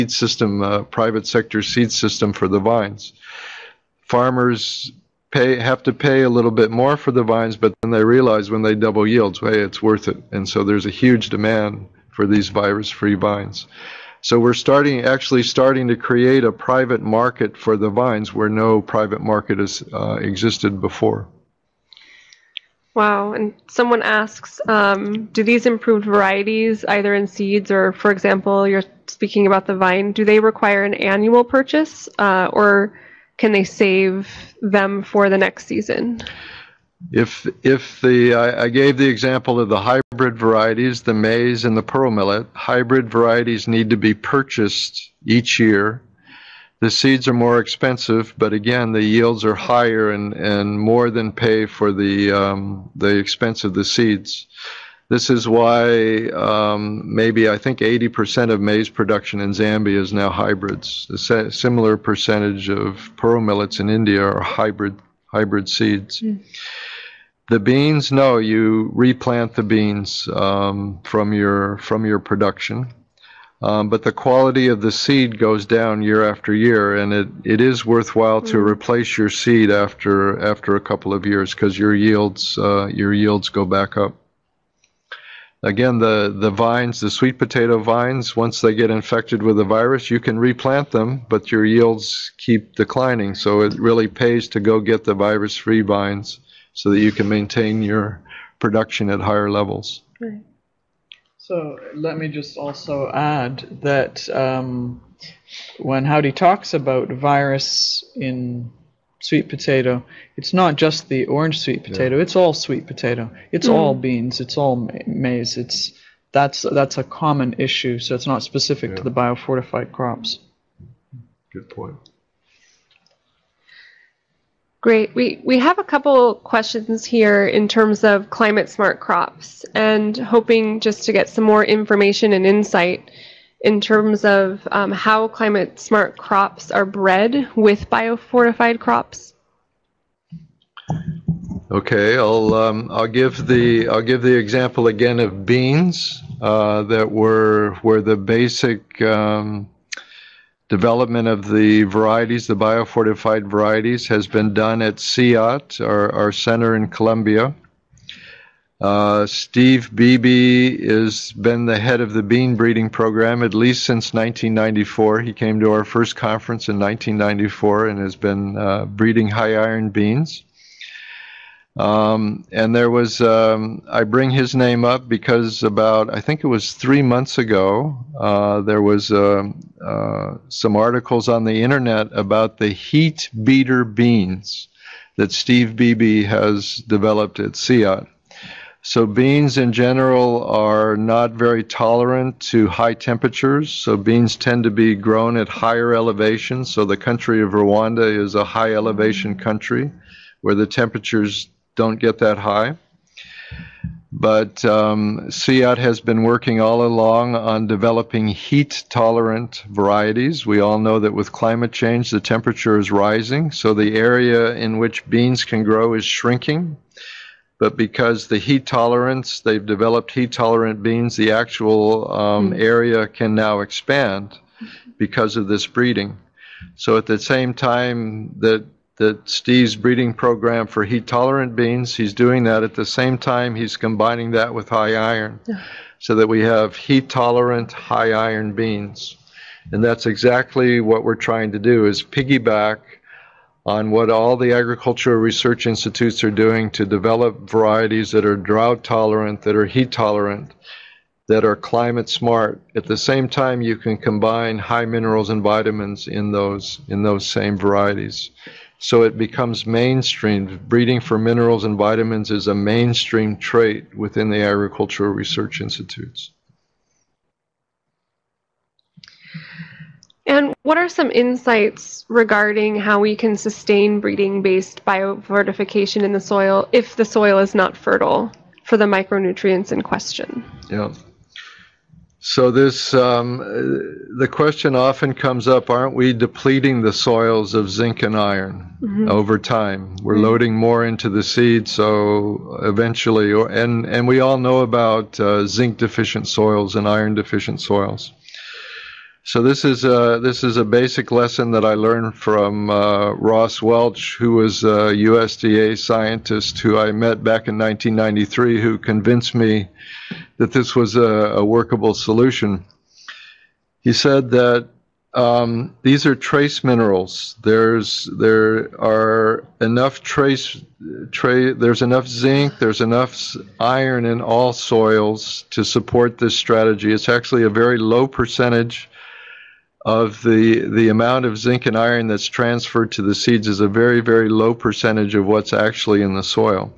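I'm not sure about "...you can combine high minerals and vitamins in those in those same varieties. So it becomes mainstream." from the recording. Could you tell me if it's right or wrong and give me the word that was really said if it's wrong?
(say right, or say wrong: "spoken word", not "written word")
right.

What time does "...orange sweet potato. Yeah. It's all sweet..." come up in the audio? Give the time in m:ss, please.
1:51.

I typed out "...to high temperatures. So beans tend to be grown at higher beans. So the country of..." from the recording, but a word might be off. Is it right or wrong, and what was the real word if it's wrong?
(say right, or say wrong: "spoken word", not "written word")
wrong: "elevations", not "beans".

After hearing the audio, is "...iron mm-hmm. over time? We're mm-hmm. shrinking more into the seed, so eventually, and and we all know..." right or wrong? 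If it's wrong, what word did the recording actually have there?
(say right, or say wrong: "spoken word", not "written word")
wrong: "loading", not "shrinking".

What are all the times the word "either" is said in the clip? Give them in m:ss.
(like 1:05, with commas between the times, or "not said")
0:26.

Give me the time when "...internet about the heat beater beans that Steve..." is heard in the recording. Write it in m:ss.
3:01.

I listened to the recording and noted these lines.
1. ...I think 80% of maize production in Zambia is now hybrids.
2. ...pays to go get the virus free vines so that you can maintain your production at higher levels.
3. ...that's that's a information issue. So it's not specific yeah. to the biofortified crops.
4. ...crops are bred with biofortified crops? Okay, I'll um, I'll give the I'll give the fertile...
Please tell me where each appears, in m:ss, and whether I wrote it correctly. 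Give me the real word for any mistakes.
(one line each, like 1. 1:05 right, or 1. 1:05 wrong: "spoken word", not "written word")
1. 0:57 right
2. 1:34 right
3. 1:56 wrong: "common", not "information"
4. 2:16 wrong: "example", not "fertile".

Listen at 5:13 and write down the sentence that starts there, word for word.
He said that um, these are trace minerals.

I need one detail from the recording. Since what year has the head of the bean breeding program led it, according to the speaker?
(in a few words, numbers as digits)
1994.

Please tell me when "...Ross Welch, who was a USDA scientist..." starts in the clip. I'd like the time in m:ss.
5:03.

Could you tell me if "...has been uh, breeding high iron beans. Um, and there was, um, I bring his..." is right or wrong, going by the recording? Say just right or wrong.
right.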